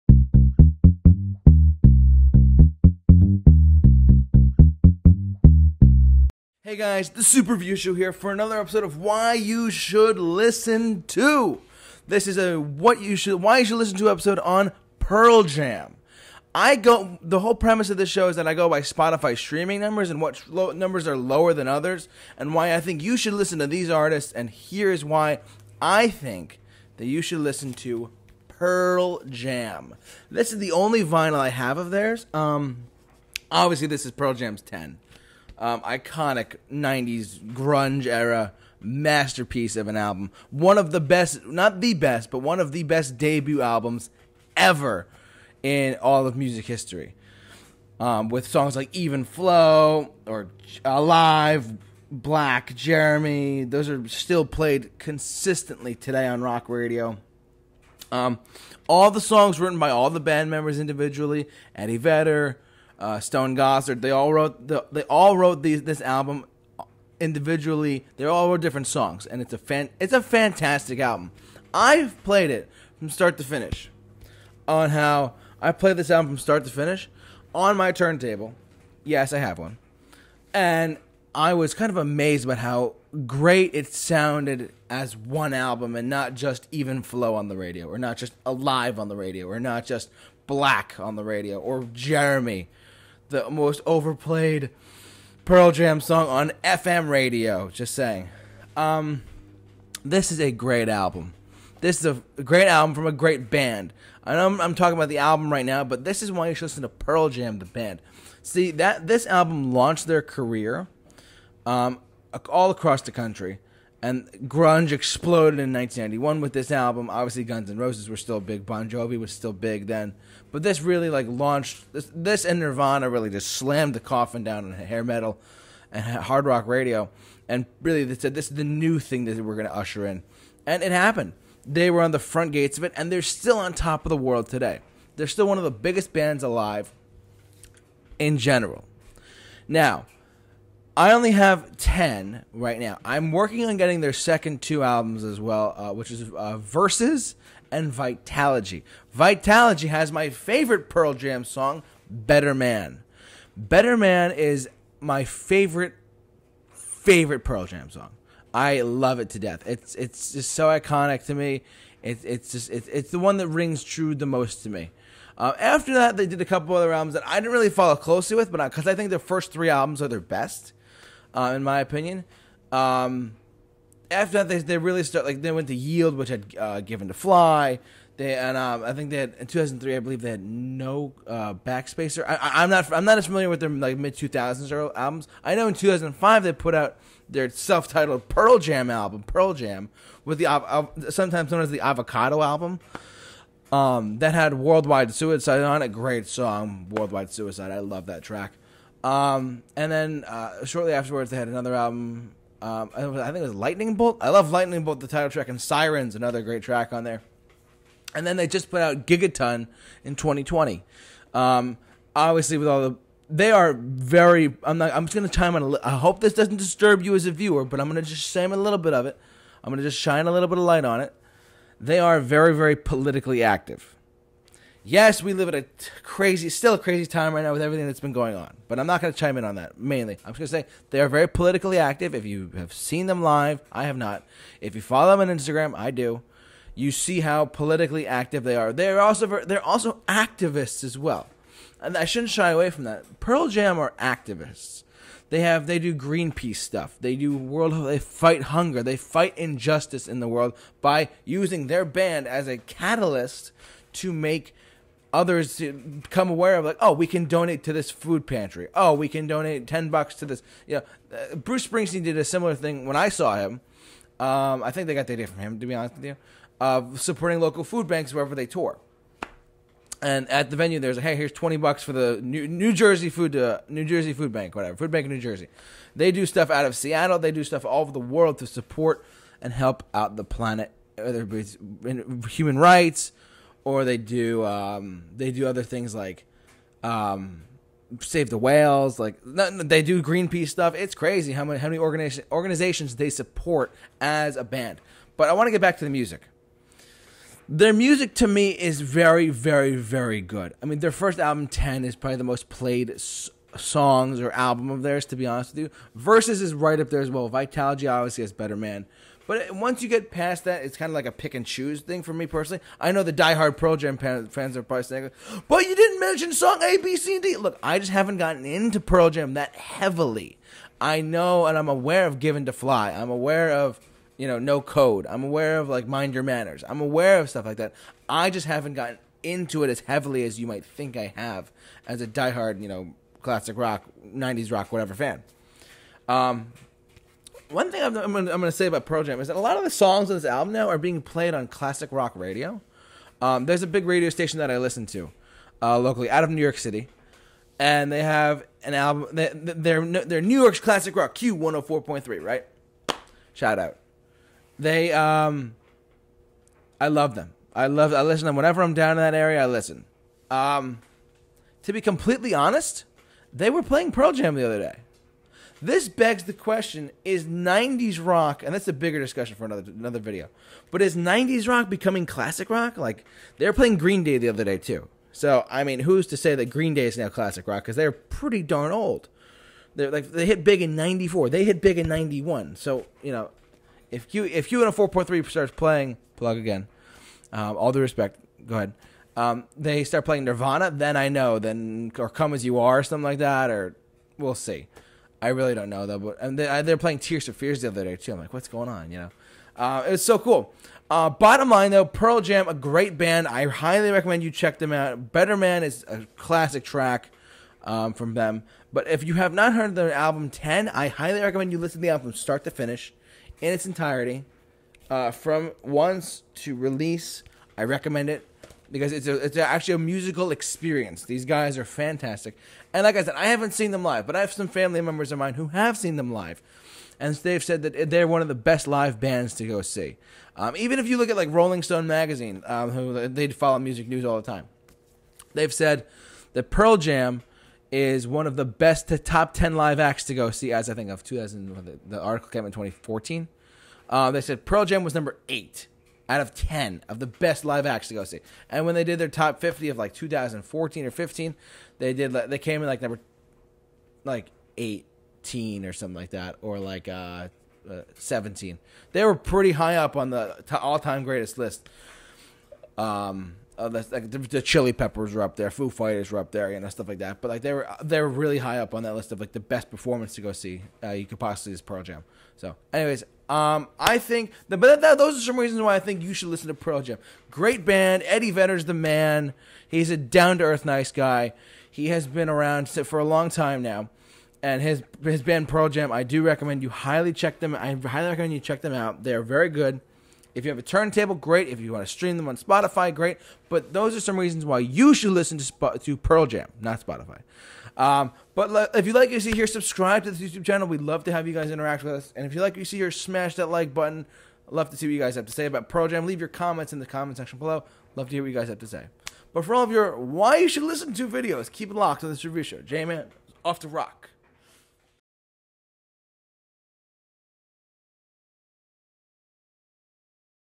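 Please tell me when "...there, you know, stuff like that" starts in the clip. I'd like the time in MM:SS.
07:46.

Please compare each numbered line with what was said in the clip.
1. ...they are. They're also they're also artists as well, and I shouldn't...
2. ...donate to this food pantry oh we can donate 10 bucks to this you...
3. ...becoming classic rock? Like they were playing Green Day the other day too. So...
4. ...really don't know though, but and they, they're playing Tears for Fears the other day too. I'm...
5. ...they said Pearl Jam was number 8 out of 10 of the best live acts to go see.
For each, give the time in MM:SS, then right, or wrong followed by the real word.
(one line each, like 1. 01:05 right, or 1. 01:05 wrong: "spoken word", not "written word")
1. 03:58 wrong: "activists", not "artists"
2. 04:17 right
3. 06:11 right
4. 06:35 right
5. 07:24 right.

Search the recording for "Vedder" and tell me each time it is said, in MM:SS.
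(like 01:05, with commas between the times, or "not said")
01:01, 07:58.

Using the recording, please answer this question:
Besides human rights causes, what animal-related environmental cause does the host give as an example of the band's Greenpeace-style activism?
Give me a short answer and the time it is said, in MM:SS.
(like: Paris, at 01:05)
Save the whales, at 04:47.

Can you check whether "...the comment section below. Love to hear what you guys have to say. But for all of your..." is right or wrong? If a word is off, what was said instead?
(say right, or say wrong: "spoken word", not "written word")
right.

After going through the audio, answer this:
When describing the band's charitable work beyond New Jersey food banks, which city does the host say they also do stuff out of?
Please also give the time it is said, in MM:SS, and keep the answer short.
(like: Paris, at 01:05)
Seattle, at 04:36.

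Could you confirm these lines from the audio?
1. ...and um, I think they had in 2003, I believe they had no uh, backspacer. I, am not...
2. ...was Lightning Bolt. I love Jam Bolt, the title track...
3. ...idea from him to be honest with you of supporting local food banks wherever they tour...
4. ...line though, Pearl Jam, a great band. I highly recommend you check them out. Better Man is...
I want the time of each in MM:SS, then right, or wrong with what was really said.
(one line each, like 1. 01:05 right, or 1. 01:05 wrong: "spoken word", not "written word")
1. 02:58 right
2. 03:23 wrong: "Lightning", not "Jam"
3. 04:25 right
4. 06:41 right.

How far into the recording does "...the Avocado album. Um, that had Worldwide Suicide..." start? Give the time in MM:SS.
03:11.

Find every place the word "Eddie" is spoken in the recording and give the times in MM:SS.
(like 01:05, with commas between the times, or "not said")
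01:01, 07:58.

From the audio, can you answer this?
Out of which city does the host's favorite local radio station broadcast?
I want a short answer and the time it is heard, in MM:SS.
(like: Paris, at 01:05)
New York City, at 05:46.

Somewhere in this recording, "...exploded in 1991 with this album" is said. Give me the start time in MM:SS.
01:54.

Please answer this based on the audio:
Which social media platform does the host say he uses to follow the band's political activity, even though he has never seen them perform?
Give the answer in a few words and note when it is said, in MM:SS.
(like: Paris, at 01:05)
Instagram, at 03:55.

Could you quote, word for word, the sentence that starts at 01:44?
I know I'm, I'm talking about the album right now, but this is why you should listen to Pearl Jam, the band.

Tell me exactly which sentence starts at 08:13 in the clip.
But those are some reasons why you should listen to Sp- to Pearl Jam, not Spotify.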